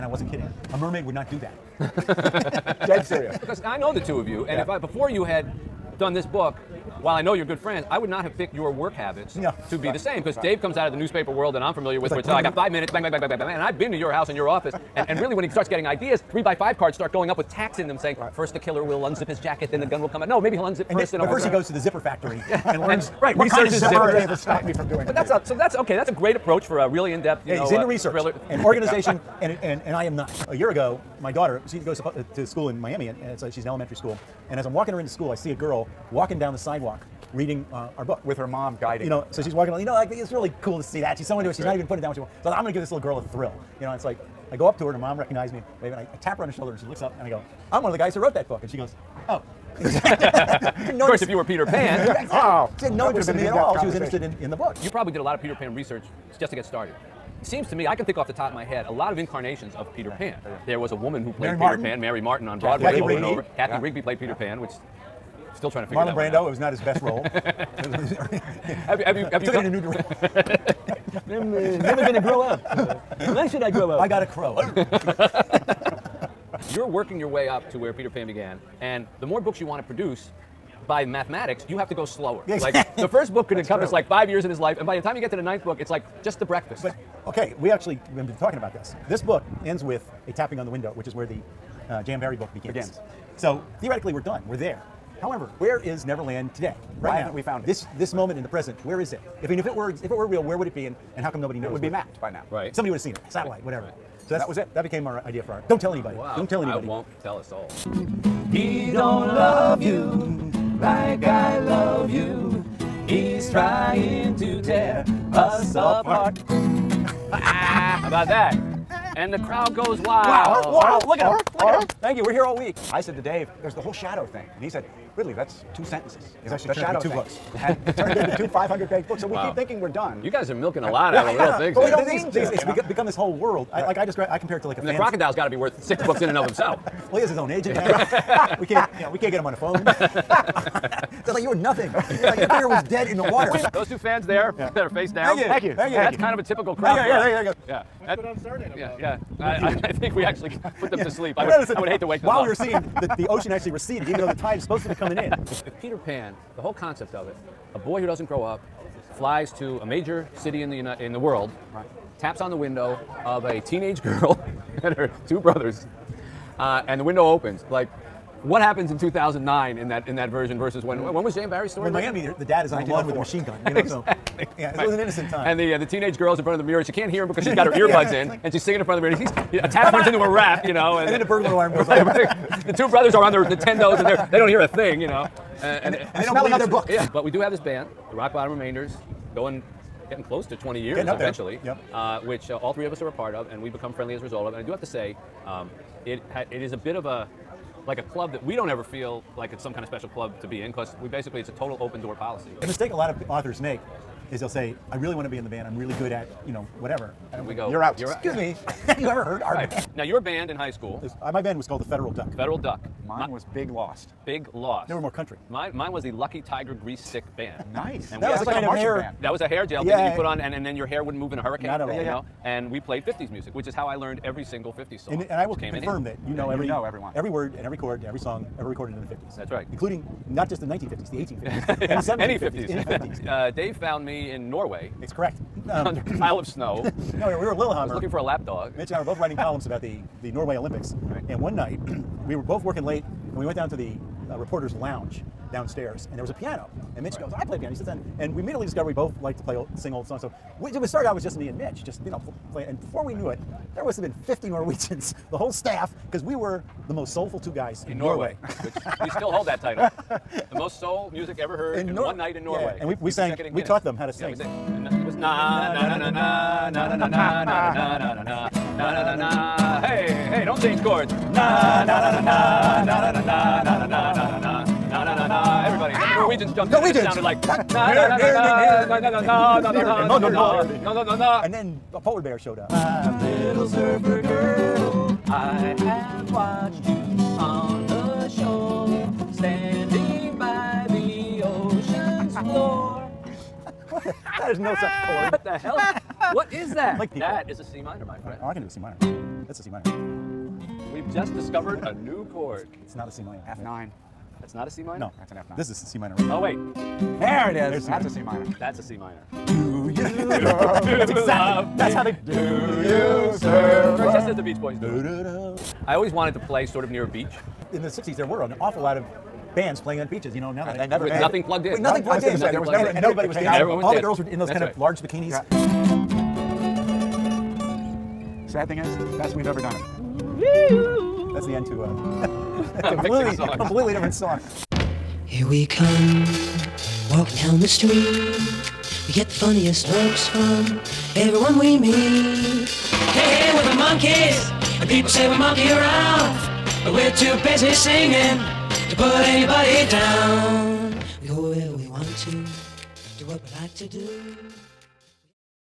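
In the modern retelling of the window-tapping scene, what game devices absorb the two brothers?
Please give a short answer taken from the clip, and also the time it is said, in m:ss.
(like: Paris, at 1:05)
Nintendos, at 3:03.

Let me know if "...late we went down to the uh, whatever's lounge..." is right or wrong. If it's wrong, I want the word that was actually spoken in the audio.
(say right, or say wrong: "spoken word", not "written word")
wrong: "reporter", not "whatever".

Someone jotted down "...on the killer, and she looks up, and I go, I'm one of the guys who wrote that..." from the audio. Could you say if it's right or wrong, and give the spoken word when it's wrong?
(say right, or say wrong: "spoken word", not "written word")
wrong: "shoulder", not "killer".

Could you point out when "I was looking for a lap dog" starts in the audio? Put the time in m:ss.
3:57.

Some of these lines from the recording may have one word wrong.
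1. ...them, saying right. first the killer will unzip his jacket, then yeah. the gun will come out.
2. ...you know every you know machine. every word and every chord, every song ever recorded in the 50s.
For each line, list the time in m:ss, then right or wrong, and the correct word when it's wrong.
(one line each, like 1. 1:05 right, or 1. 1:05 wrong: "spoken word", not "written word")
1. 0:17 right
2. 3:46 wrong: "everyone", not "machine".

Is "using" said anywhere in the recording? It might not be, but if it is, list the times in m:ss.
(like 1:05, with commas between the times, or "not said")
not said.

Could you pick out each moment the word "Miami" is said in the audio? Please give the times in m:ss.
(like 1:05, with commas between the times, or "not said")
0:32, 2:52.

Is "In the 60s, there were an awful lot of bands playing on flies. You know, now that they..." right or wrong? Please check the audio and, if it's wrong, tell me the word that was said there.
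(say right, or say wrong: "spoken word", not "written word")
wrong: "beaches", not "flies".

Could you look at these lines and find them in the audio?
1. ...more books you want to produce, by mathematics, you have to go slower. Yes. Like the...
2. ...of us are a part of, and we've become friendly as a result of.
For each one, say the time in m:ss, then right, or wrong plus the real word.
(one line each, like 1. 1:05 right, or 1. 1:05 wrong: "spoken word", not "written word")
1. 1:19 right
2. 3:12 right.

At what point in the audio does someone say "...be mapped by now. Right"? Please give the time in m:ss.
1:41.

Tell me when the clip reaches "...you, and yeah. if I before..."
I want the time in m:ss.
0:04.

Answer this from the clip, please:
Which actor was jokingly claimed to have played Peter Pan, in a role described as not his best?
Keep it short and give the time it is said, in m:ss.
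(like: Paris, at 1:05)
Marlon Brando, at 1:05.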